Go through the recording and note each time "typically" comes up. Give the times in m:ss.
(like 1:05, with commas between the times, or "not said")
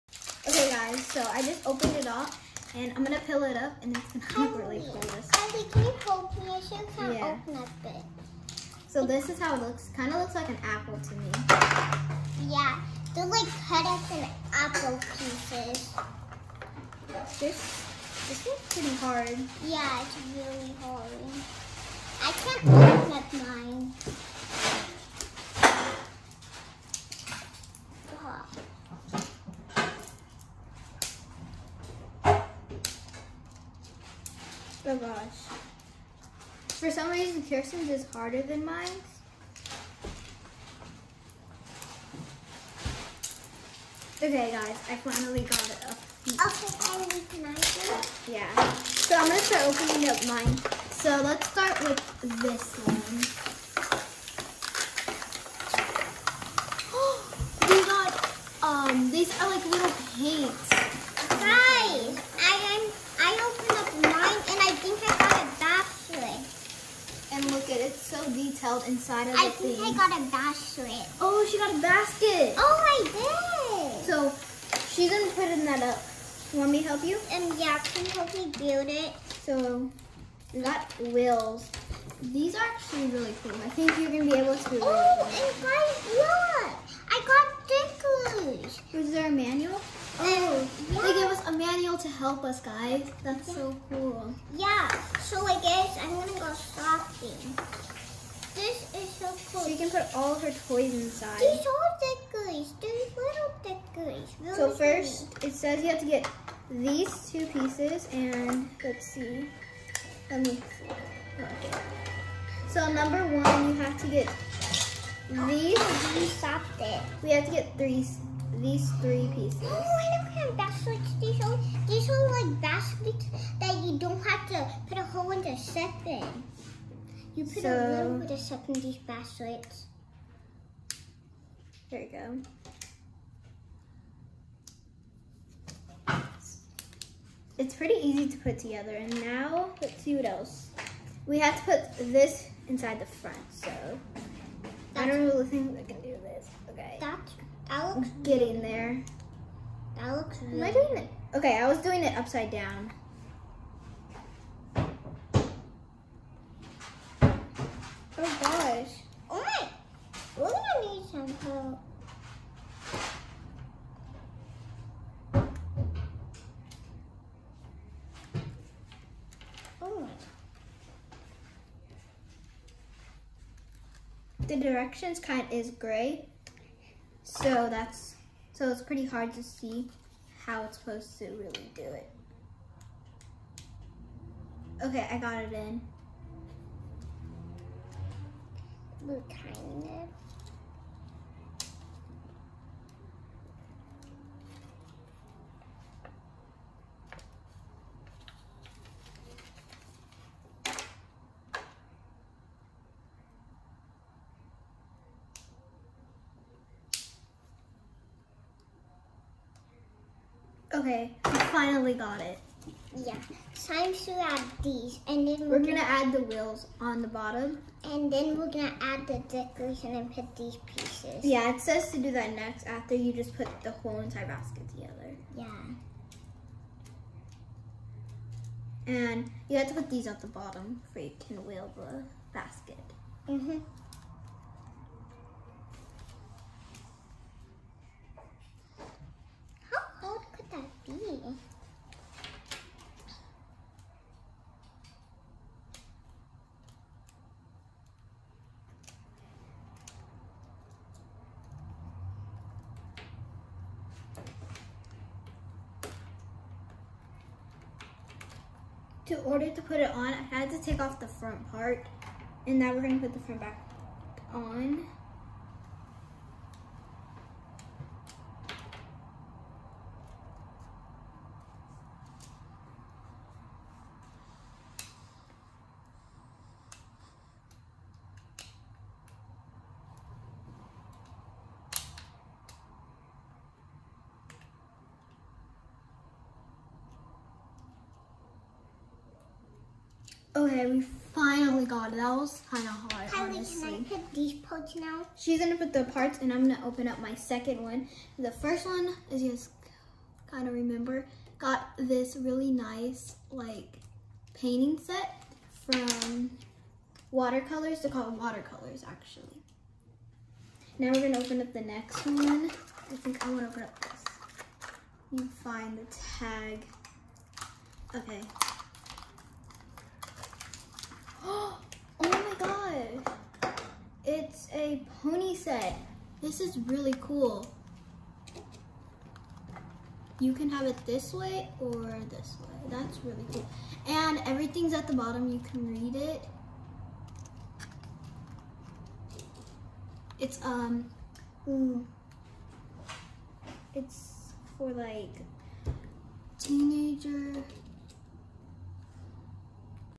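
not said.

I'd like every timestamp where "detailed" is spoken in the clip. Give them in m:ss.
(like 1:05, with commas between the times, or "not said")
1:08.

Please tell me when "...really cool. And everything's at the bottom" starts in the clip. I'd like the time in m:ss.
5:33.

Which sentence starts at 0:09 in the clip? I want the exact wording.
Kind of looks like an apple to me.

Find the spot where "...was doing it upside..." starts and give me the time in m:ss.
2:31.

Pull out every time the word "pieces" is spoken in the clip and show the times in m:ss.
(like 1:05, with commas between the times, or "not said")
0:15, 1:47, 1:59, 3:40.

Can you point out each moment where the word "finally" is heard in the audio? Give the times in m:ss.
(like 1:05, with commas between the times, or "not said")
0:45, 3:31, 4:51.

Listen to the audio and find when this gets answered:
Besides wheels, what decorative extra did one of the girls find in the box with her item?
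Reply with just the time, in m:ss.
1:28.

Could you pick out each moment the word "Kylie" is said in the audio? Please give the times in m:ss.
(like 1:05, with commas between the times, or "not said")
0:04, 4:53.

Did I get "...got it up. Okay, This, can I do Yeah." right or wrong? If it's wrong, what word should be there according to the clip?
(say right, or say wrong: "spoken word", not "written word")
wrong: "Emily", not "This".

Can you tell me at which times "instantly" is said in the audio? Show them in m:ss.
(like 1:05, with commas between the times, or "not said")
not said.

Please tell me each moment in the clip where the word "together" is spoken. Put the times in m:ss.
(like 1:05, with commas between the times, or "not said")
2:18, 3:44.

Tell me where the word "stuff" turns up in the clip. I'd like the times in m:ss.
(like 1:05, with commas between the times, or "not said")
2:08.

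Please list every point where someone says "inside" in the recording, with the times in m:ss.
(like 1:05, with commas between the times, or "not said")
1:08, 1:40, 2:22.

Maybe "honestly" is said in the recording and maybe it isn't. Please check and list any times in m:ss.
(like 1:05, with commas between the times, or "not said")
4:53.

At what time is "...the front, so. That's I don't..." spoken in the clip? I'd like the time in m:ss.
2:22.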